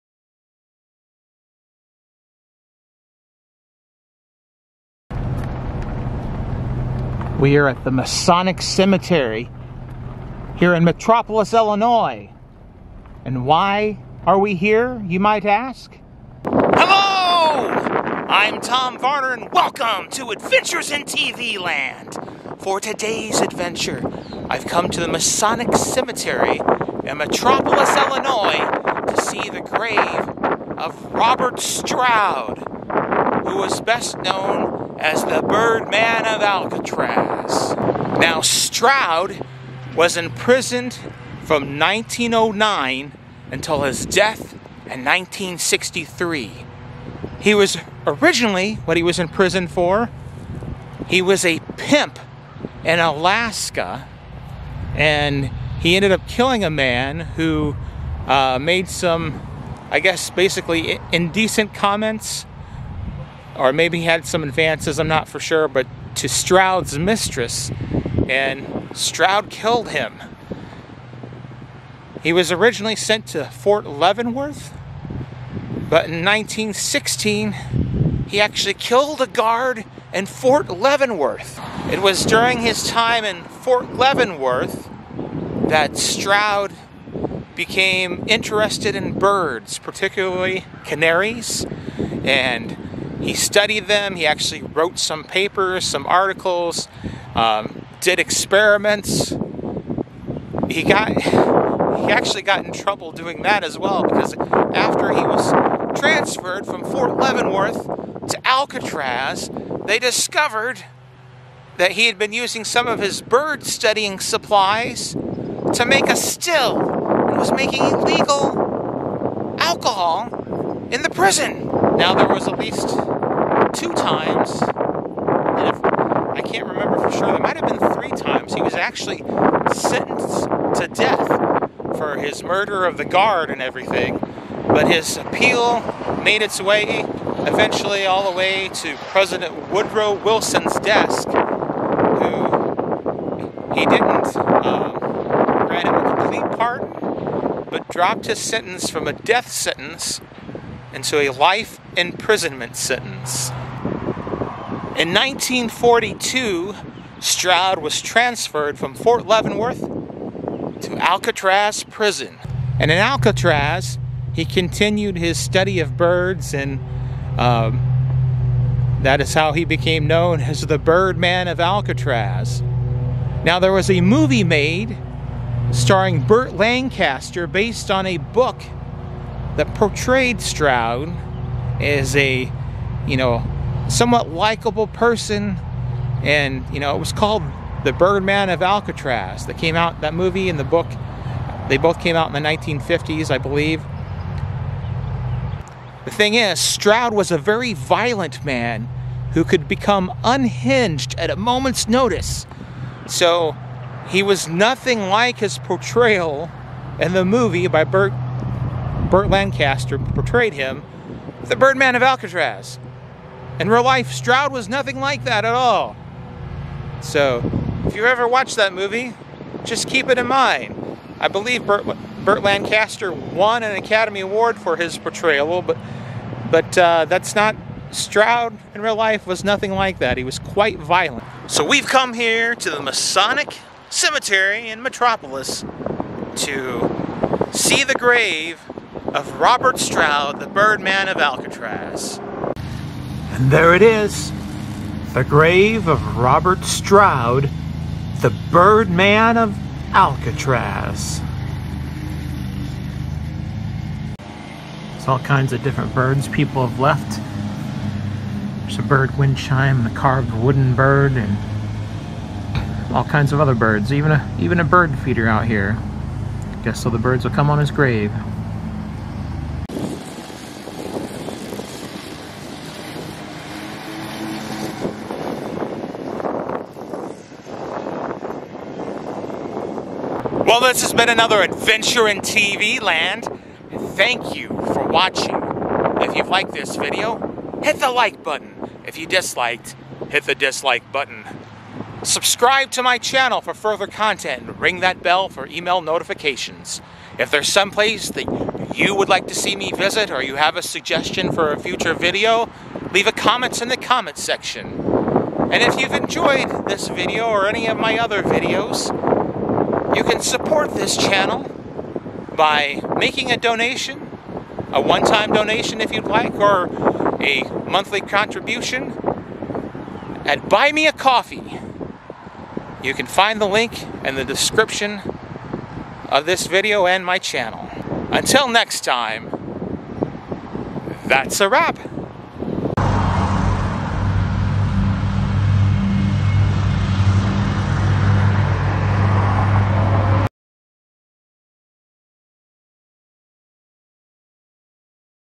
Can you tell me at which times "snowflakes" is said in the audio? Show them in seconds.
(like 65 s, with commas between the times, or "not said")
not said.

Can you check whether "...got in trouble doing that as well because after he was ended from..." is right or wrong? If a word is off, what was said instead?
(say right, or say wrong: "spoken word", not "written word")
wrong: "transferred", not "ended".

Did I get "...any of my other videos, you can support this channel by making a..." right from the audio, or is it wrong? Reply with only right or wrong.
right.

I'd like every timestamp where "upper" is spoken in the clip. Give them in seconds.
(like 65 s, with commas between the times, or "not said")
not said.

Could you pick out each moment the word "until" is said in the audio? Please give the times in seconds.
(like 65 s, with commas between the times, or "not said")
43 s, 328 s.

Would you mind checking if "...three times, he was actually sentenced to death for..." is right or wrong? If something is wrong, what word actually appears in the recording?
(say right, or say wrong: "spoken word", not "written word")
right.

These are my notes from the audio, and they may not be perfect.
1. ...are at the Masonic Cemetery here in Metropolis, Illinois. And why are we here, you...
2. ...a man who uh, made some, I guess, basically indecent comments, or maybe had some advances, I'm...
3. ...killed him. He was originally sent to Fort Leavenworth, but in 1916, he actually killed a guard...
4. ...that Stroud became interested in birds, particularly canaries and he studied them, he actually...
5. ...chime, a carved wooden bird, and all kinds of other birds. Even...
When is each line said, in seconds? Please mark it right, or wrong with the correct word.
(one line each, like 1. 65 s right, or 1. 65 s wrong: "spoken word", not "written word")
1. 7 s right
2. 56 s right
3. 69 s right
4. 85 s right
5. 259 s right.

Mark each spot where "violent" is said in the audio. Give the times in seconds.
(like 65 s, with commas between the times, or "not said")
197 s, 230 s.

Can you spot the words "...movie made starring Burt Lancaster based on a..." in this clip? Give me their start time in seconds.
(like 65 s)
174 s.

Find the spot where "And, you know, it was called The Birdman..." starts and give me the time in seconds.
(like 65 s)
186 s.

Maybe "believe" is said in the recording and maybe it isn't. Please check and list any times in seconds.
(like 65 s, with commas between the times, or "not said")
193 s, 221 s.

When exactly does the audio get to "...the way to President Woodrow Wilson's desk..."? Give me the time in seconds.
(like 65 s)
138 s.